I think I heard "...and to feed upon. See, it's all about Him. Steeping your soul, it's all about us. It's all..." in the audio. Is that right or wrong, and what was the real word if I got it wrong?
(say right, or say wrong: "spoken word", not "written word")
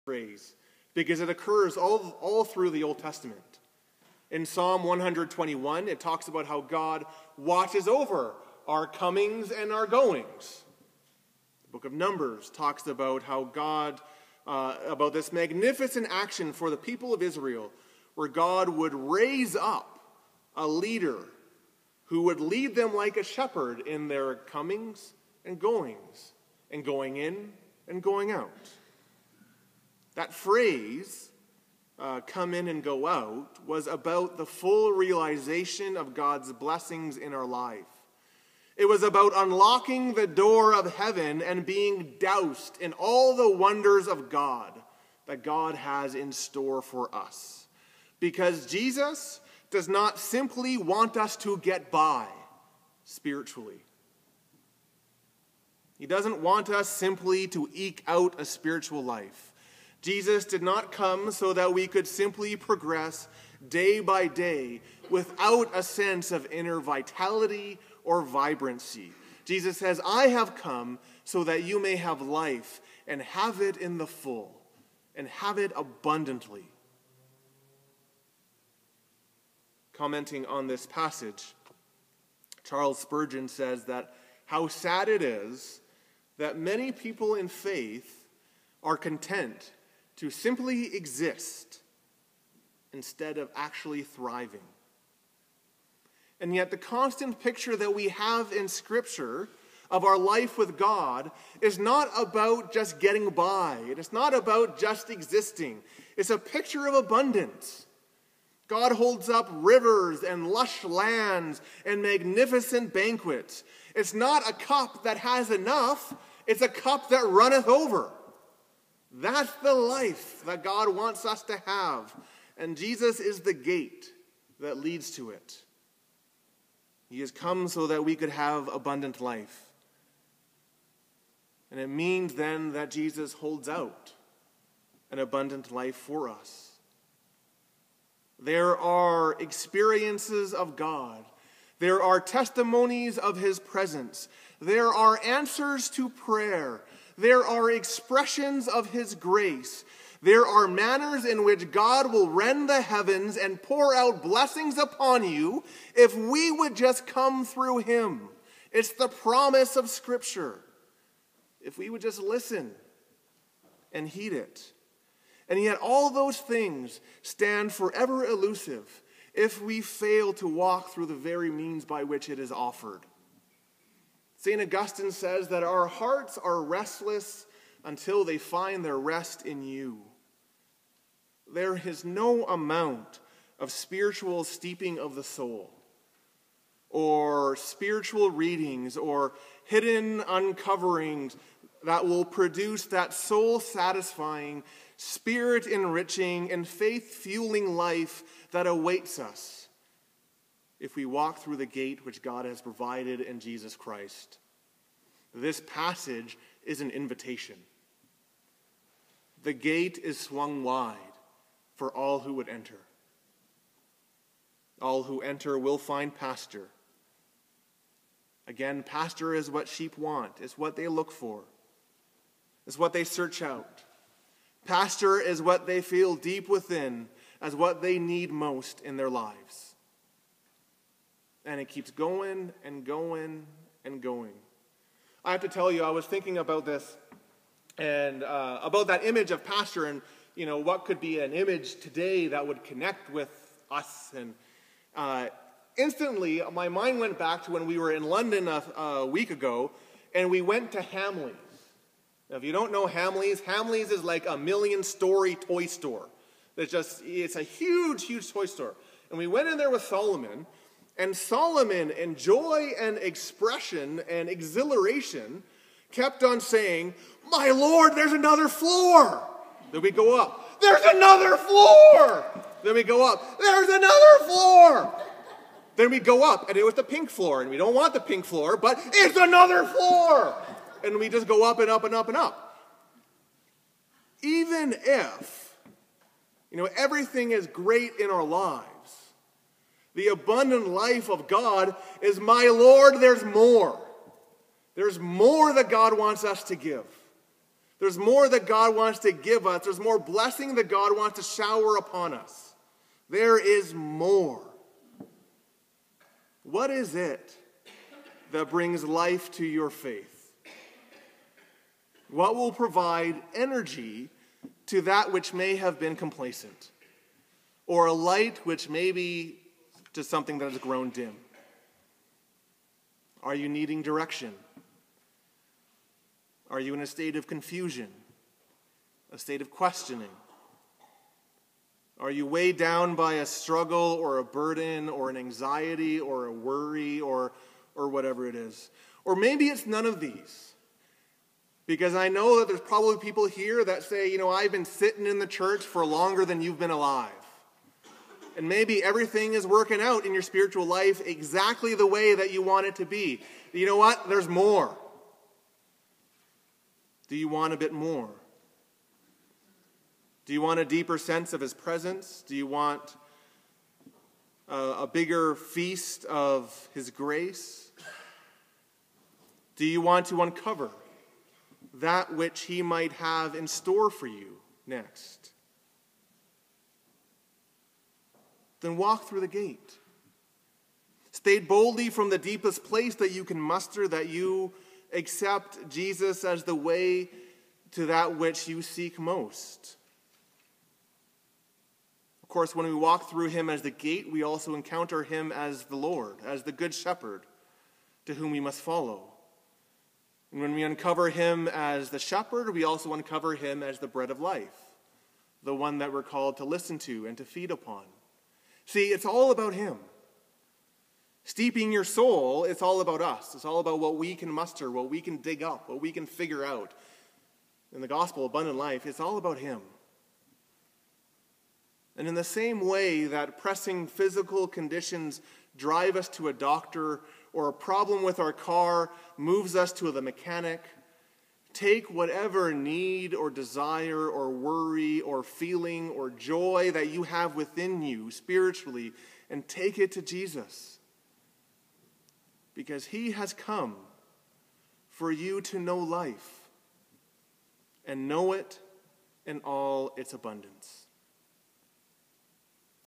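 right.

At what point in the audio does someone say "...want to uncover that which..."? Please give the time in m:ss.
6:09.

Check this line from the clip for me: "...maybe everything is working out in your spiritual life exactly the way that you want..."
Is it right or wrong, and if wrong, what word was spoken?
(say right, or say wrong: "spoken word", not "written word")
right.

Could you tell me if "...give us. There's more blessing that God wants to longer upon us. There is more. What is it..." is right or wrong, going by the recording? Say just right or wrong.
wrong.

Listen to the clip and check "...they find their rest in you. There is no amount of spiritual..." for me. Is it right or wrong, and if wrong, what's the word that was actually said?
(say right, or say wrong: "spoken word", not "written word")
right.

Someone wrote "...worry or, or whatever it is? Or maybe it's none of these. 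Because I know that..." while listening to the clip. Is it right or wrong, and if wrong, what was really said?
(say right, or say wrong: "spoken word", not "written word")
right.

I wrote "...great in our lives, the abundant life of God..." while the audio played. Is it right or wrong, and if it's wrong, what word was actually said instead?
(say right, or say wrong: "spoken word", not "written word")
right.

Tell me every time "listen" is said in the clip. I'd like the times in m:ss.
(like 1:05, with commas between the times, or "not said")
2:42, 6:46.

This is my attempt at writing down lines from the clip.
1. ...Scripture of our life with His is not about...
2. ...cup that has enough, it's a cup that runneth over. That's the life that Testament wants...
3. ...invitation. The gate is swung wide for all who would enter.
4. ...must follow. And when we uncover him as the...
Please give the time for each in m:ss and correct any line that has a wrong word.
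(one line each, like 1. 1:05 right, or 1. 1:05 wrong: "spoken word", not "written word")
1. 1:38 wrong: "God", not "His"
2. 1:54 wrong: "God", not "Testament"
3. 3:26 right
4. 6:38 right.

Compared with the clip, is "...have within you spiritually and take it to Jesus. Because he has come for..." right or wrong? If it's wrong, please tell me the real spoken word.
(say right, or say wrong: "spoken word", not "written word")
right.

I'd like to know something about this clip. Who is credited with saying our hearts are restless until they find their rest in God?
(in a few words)
St. Augustine.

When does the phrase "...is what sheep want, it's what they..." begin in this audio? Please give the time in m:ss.
3:39.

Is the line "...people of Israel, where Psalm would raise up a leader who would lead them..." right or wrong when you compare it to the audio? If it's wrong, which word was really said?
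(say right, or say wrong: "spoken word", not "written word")
wrong: "God", not "Psalm".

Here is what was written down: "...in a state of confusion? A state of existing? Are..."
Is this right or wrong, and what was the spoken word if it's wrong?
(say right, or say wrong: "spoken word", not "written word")
wrong: "questioning", not "existing".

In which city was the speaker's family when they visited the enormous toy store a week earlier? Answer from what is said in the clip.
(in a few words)
London.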